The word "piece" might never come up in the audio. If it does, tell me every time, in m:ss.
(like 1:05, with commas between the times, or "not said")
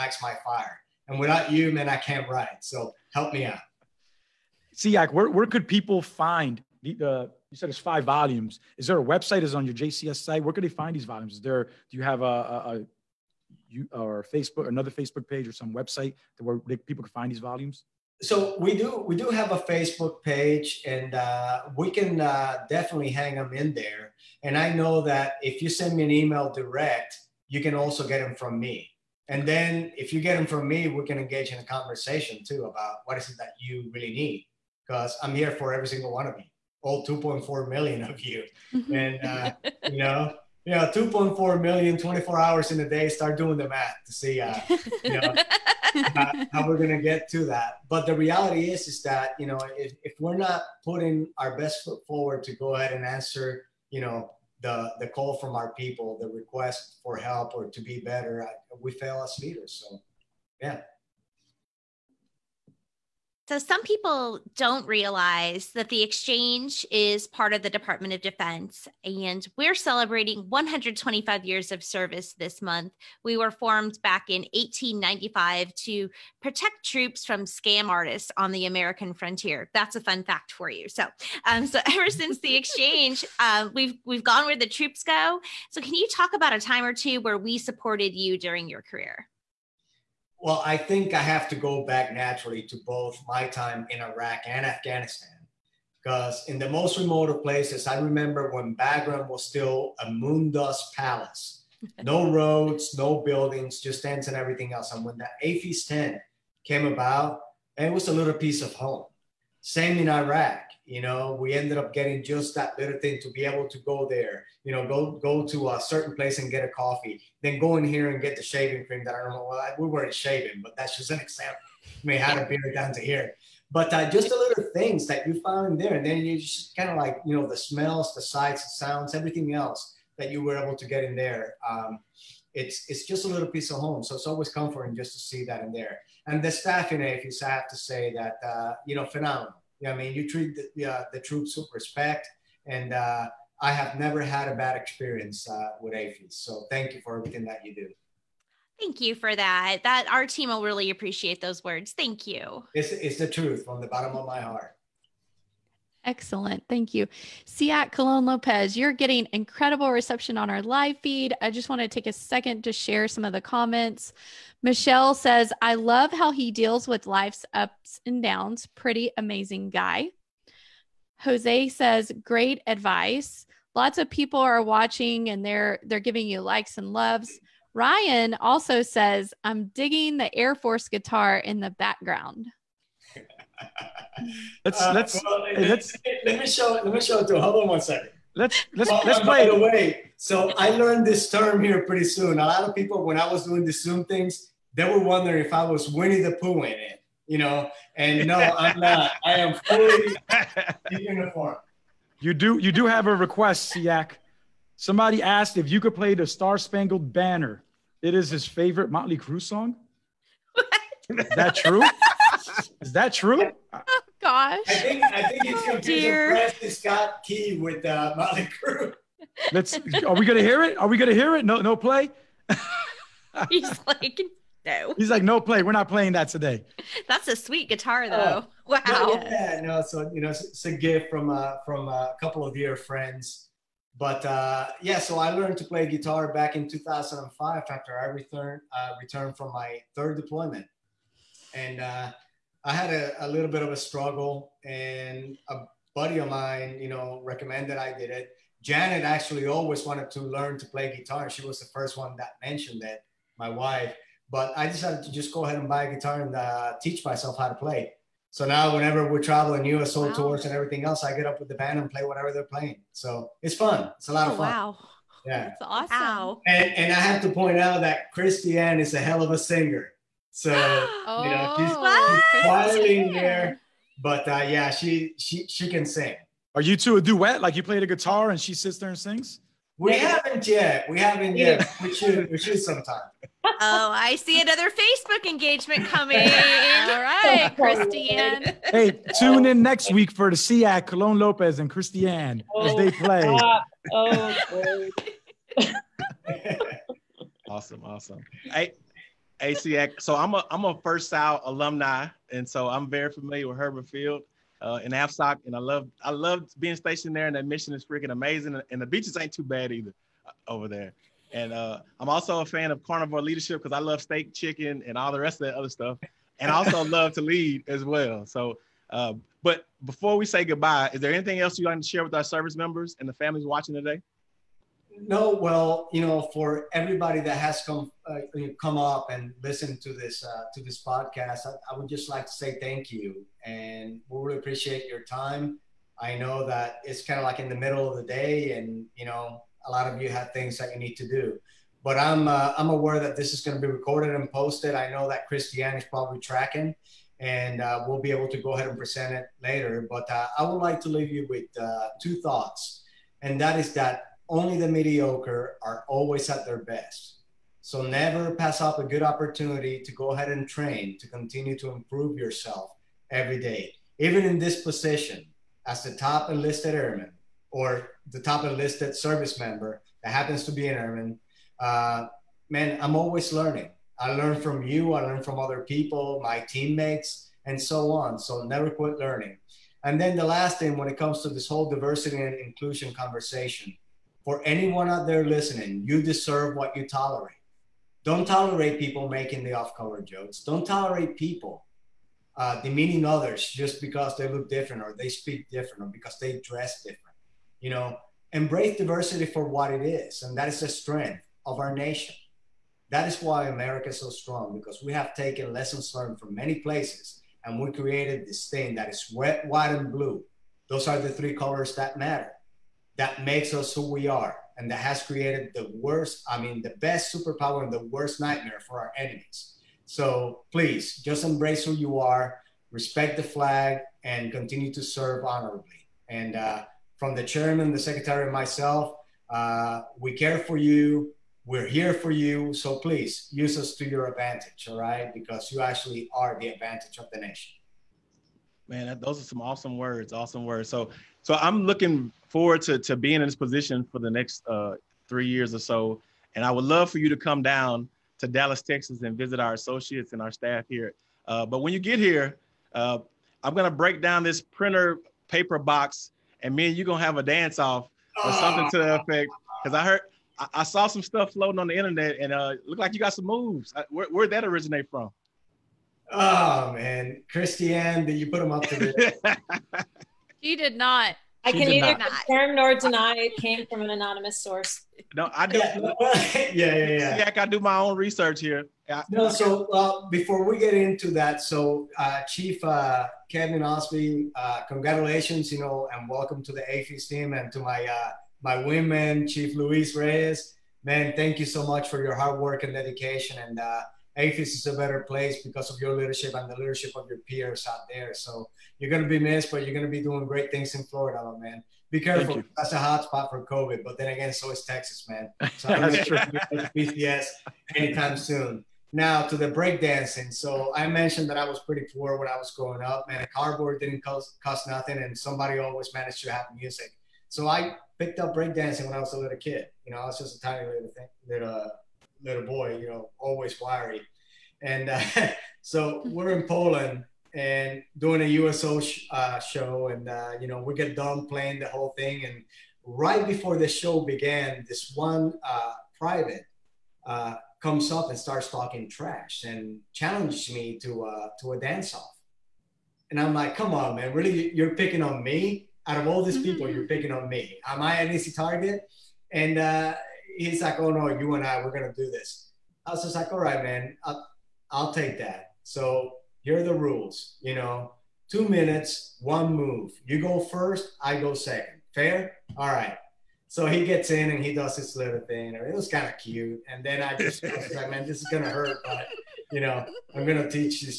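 1:48, 2:13.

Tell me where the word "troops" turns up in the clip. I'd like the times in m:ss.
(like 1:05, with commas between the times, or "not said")
1:16, 1:24, 2:21.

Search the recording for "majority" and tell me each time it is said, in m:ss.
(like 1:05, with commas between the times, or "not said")
not said.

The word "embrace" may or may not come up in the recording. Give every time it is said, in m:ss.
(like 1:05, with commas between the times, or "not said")
6:38, 7:01.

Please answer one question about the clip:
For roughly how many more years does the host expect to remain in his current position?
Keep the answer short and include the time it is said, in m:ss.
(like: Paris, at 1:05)
3, at 7:25.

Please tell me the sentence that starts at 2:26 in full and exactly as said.
So thank you for everything that you do.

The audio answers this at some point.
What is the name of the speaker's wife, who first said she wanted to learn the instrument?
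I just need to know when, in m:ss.
4:08.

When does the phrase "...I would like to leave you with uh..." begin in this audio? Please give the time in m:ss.
5:50.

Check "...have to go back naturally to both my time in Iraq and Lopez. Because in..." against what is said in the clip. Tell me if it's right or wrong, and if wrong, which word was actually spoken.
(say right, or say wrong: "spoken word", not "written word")
wrong: "Afghanistan", not "Lopez".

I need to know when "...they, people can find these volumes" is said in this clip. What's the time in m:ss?
0:16.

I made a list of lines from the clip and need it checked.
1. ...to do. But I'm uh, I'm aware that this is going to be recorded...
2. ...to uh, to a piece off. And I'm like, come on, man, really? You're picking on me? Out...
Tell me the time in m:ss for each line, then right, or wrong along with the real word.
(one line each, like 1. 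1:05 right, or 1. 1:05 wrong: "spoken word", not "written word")
1. 5:40 right
2. 9:00 wrong: "dance", not "piece".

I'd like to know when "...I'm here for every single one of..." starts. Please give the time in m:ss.
0:35.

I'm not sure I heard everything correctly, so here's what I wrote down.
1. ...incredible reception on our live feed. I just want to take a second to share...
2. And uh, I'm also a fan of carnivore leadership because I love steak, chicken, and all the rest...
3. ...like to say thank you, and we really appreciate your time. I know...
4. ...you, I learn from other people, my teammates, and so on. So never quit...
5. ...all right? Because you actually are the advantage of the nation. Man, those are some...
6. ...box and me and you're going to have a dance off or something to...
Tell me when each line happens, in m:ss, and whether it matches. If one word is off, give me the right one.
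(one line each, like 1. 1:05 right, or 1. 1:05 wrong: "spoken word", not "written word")
1. 2:39 right
2. 5:11 right
3. 5:32 right
4. 6:14 right
5. 7:14 right
6. 7:35 right.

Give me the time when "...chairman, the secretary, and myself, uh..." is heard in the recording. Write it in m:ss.
7:07.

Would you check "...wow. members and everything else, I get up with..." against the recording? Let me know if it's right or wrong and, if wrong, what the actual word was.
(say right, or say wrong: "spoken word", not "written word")
wrong: "tours", not "members".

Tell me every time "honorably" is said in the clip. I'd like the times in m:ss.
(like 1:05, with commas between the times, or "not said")
7:05.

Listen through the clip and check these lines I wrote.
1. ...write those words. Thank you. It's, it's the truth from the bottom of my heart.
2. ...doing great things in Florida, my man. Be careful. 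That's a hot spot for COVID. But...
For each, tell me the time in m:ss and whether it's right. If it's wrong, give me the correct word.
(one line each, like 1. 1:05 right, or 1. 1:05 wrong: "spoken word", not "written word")
1. 2:30 wrong: "appreciate", not "write"
2. 8:20 right.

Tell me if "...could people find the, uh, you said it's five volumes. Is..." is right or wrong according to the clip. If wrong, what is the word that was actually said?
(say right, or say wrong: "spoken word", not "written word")
right.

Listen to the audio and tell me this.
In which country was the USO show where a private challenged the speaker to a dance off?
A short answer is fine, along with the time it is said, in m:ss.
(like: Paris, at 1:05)
Poland, at 8:46.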